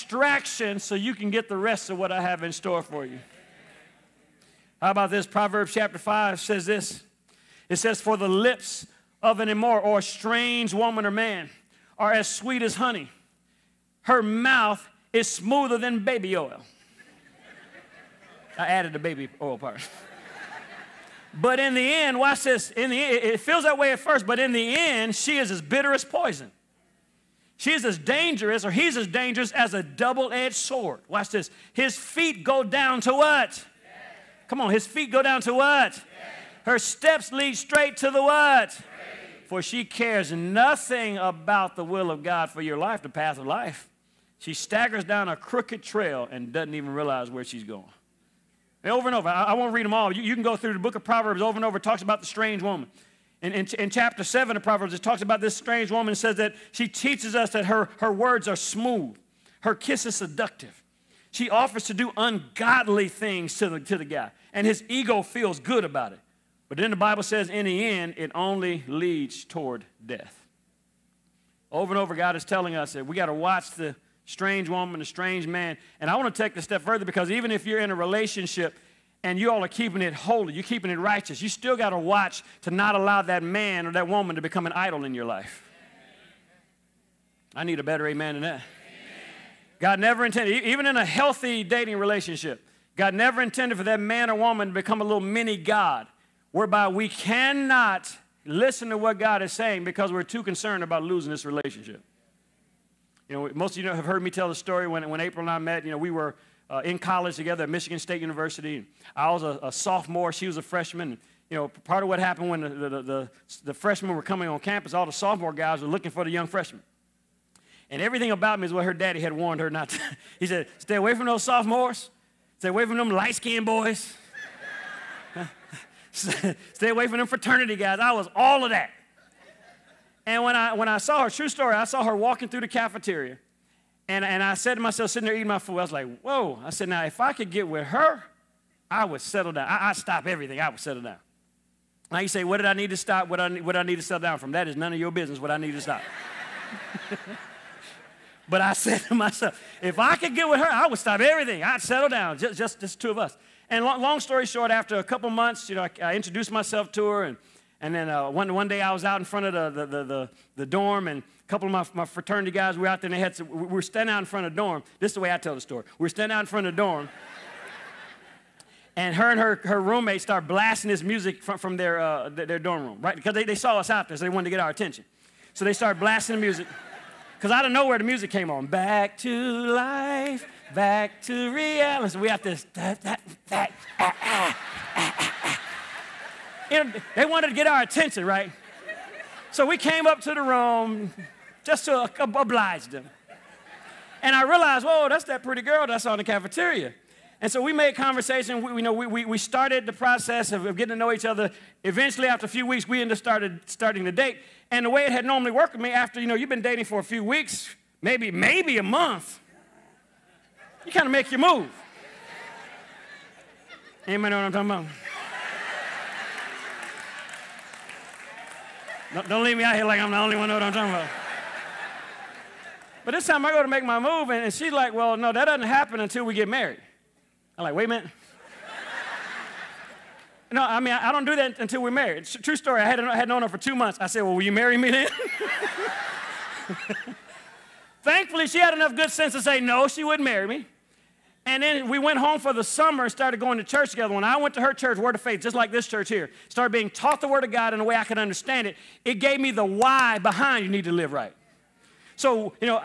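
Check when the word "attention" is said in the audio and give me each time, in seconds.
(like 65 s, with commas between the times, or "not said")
174 s, 187 s.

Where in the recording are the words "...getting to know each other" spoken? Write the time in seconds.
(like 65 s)
200 s.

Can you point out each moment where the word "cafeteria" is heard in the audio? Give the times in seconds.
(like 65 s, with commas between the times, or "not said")
132 s, 196 s.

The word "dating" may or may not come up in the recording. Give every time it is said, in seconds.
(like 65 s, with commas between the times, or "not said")
91 s, 206 s.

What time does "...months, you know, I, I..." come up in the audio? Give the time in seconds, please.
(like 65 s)
155 s.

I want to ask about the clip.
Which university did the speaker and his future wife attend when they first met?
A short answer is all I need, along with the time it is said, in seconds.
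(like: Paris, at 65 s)
Michigan State University, at 107 s.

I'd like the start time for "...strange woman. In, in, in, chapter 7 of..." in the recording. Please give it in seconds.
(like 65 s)
52 s.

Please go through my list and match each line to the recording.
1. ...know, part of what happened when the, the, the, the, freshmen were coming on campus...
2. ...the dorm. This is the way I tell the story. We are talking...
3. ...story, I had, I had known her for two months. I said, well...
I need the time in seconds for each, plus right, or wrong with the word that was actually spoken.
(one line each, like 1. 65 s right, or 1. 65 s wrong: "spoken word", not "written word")
1. 111 s right
2. 164 s wrong: "standing", not "talking"
3. 232 s right.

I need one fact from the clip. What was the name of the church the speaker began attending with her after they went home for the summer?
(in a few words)
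Word of Faith.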